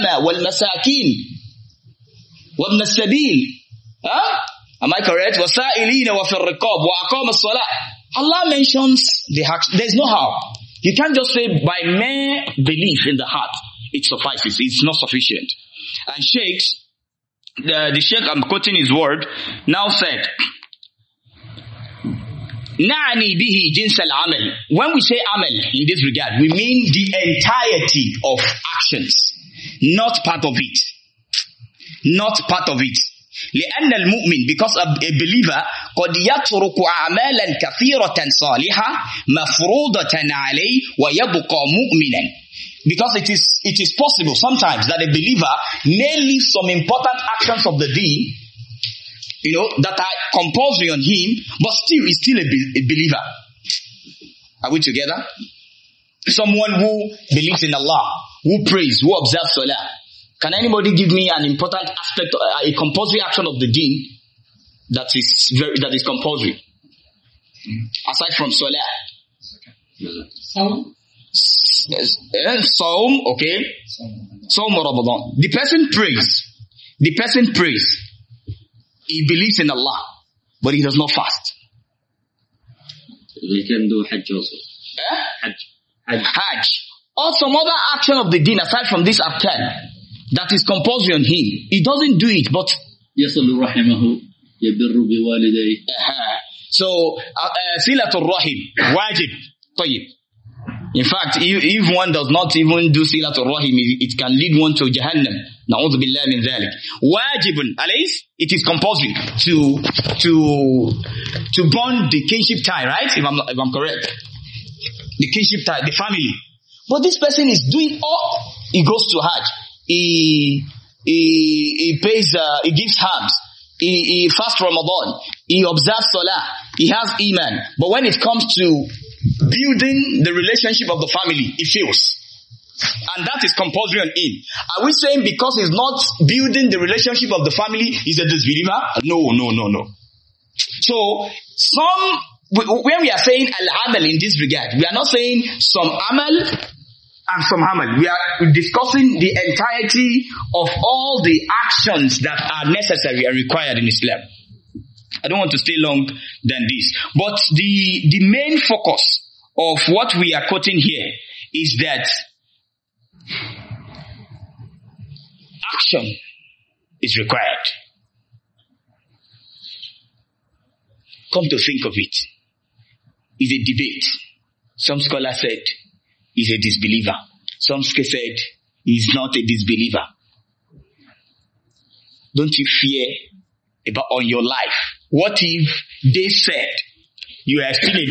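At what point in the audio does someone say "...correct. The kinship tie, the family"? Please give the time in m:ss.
1:53.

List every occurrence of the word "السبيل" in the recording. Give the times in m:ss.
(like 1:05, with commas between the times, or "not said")
0:02.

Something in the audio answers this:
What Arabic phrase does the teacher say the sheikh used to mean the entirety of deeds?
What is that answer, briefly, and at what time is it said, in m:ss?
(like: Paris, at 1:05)
Na'ani bihi jinsal amal, at 0:22.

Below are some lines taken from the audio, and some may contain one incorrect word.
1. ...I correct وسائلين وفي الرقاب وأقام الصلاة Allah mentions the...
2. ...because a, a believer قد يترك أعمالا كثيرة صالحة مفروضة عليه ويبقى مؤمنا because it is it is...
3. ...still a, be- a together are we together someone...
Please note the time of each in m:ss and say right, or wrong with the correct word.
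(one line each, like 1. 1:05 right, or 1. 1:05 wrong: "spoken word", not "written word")
1. 0:04 right
2. 0:34 right
3. 0:52 wrong: "believer", not "together".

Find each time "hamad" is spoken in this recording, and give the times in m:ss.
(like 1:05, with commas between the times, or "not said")
2:27.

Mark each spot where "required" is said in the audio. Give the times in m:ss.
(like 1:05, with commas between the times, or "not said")
2:33, 2:47.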